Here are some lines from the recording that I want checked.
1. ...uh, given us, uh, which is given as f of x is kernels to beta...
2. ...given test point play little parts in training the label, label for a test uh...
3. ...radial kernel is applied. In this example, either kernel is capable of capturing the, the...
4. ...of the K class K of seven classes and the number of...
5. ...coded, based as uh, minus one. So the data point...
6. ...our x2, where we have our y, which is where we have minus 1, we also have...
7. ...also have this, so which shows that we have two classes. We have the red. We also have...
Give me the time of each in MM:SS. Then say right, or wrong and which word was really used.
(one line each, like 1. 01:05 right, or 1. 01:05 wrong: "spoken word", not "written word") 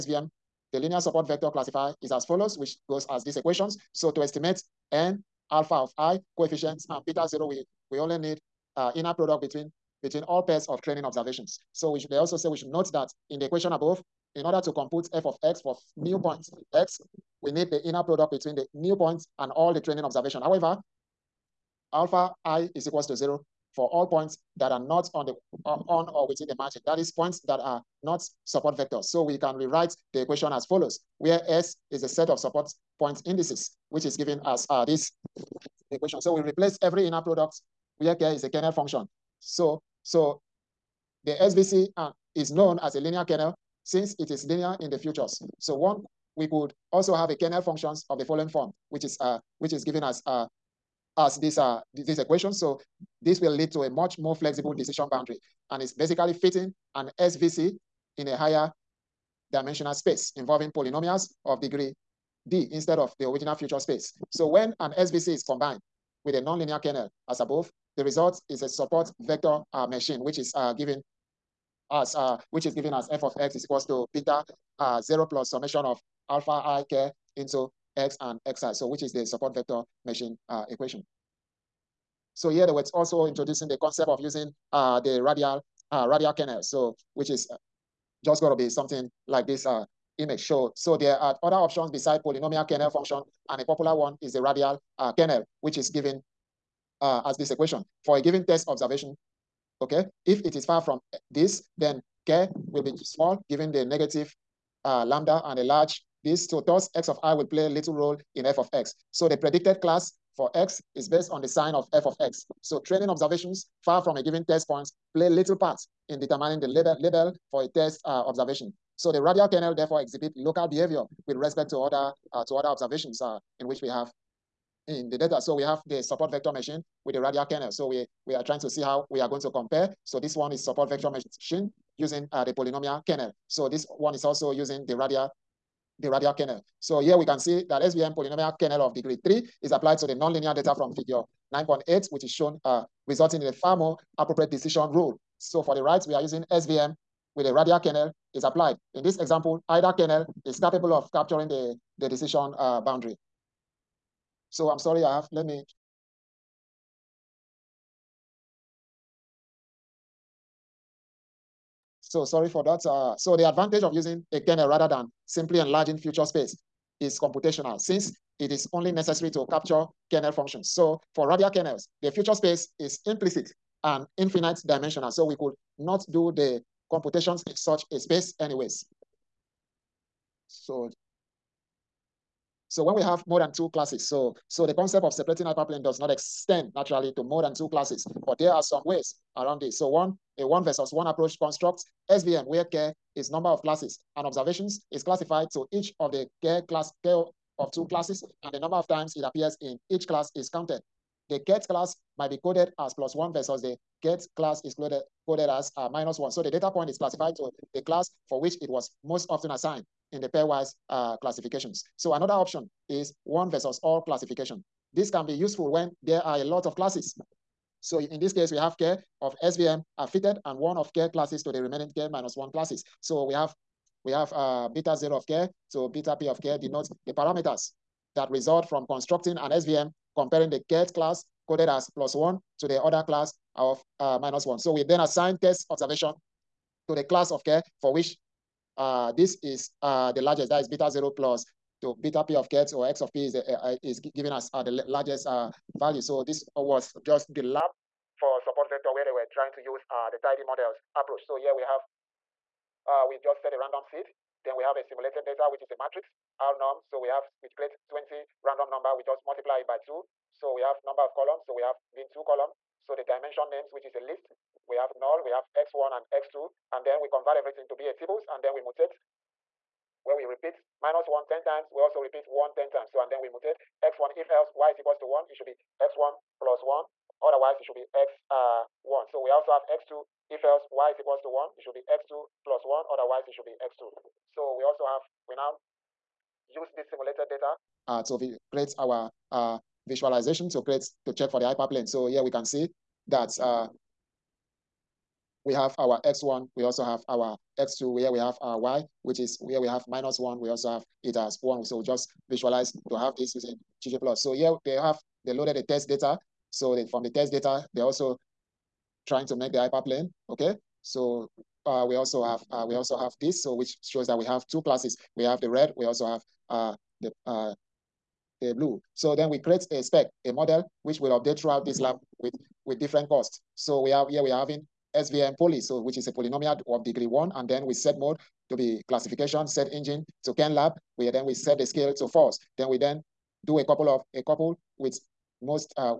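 1. 01:10 wrong: "equals", not "kernels"
2. 01:54 wrong: "determining", not "training"
3. 02:27 right
4. 03:15 wrong: "two", not "seven"
5. 03:24 wrong: "coded", not "based"
6. 04:57 right
7. 05:12 right.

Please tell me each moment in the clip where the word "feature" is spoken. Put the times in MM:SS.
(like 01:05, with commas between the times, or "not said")
00:44, 01:03, 02:45, 02:52.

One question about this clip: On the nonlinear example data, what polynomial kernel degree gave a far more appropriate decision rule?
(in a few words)
3.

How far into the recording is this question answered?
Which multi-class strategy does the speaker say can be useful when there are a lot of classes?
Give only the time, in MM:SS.
03:33.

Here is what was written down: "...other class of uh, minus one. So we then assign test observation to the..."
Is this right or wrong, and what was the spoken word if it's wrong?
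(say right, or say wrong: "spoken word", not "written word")
right.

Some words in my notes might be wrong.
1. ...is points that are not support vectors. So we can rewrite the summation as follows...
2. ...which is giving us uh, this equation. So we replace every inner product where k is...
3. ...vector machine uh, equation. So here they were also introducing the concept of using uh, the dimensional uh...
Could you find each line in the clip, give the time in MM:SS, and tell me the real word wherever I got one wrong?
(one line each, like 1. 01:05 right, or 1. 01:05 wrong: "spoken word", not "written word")
1. 00:26 wrong: "equation", not "summation"
2. 00:33 right
3. 01:19 wrong: "radial", not "dimensional".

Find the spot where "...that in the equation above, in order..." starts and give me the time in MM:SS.
00:12.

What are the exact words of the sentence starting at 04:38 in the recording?
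Uh, so we also have x2 if else y is equals to 1, it should be x2 plus 1.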